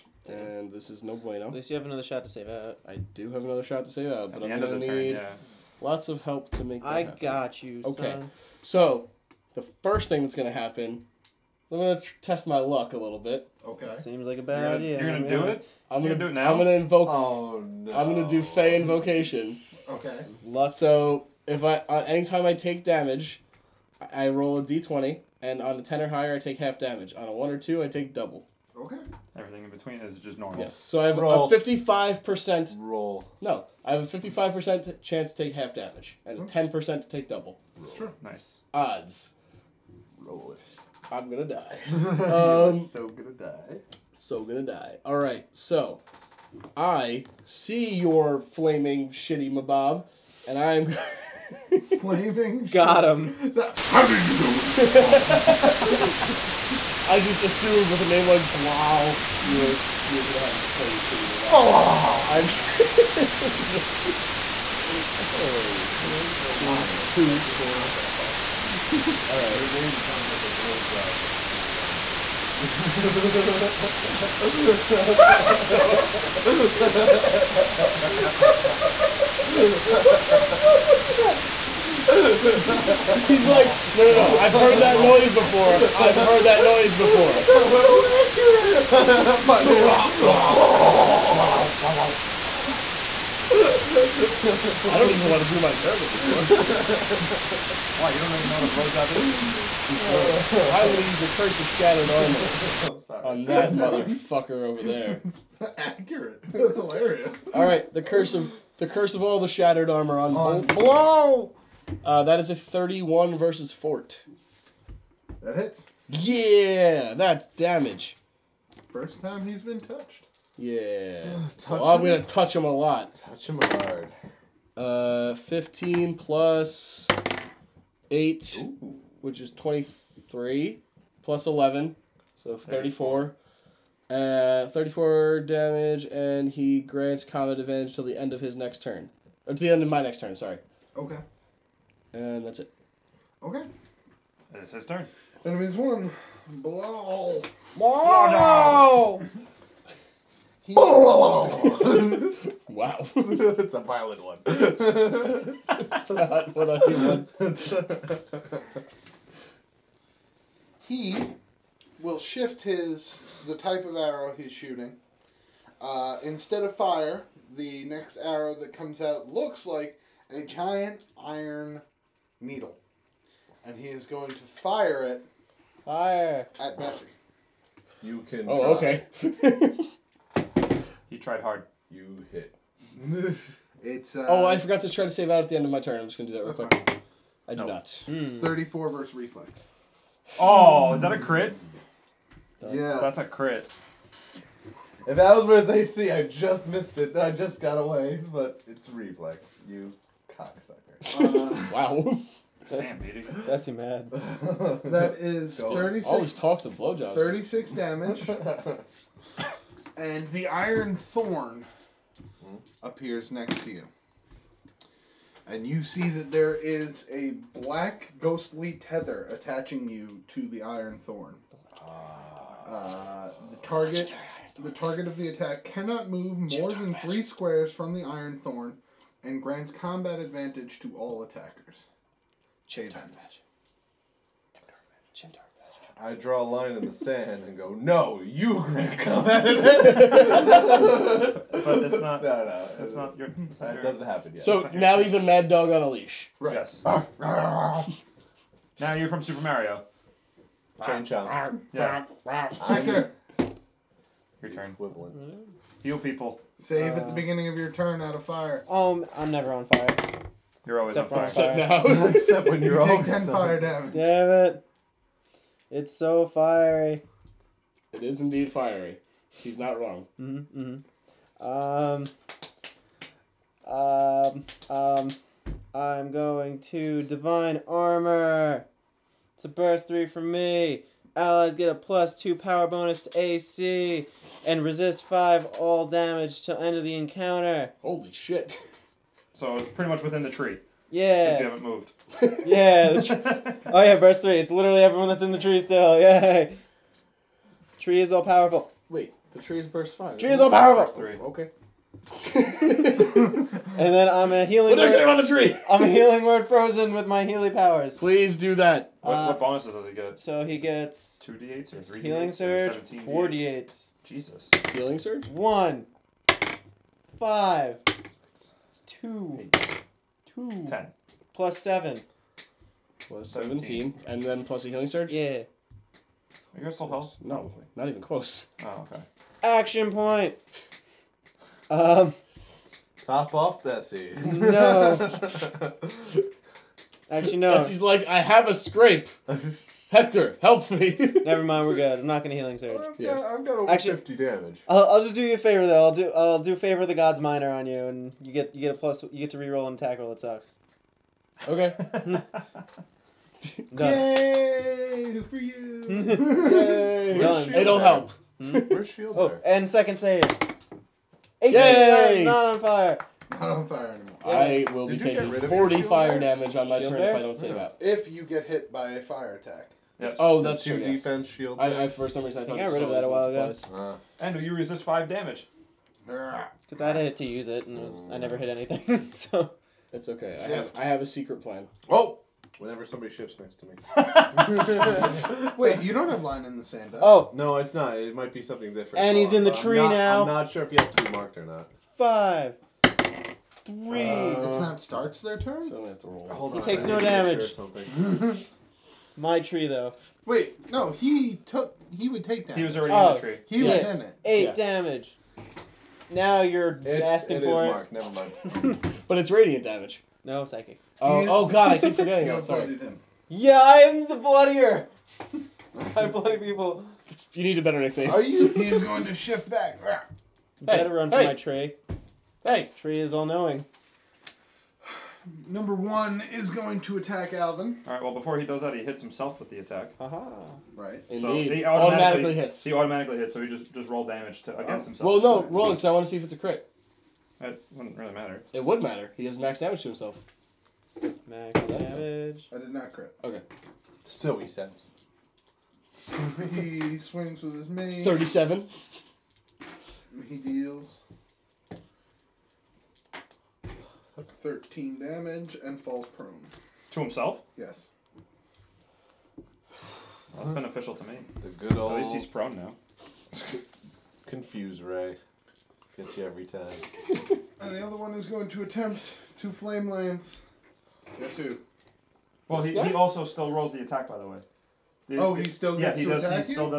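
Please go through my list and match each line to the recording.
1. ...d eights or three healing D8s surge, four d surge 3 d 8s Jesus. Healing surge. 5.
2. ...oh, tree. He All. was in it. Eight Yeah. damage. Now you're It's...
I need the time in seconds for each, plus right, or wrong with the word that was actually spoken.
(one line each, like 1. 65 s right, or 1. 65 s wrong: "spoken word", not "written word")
1. 311 s wrong: "4", not "3"
2. 403 s wrong: "Yes", not "All".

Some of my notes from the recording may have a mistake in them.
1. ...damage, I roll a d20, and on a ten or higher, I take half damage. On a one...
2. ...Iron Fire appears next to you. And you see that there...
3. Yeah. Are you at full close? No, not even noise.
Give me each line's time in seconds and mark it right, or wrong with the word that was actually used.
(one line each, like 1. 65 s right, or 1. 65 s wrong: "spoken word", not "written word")
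1. 22 s right
2. 210 s wrong: "Thorn", not "Fire"
3. 325 s wrong: "close", not "noise".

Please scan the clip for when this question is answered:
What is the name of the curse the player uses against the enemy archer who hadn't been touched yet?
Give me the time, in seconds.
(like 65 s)
101 s.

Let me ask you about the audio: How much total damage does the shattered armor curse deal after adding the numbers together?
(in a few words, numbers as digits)
34.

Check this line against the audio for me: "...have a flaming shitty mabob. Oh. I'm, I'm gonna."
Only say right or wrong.
right.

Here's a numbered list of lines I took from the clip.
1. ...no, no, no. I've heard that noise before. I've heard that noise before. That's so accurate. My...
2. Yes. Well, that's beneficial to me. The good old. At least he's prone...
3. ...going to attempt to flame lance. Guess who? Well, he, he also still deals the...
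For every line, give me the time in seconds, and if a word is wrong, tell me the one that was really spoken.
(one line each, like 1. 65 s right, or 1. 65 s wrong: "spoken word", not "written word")
1. 83 s right
2. 457 s right
3. 468 s wrong: "rolls", not "deals".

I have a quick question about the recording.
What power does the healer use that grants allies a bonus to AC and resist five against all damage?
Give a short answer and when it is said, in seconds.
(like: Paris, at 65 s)
Divine Armor, at 277 s.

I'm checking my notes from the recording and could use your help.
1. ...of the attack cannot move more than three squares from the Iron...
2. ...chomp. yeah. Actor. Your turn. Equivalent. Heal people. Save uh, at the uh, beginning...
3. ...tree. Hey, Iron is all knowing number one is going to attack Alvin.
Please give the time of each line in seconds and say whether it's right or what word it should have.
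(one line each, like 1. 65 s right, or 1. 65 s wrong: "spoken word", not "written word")
1. 225 s right
2. 251 s right
3. 421 s wrong: "Tree", not "Iron".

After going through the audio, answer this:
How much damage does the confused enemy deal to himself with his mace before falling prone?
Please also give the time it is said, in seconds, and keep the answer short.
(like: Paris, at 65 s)
13, at 454 s.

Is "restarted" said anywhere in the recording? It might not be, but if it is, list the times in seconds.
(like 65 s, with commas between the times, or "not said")
not said.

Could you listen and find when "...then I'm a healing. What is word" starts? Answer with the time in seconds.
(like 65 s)
303 s.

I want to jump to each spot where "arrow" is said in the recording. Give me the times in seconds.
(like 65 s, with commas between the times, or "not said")
163 s, 168 s.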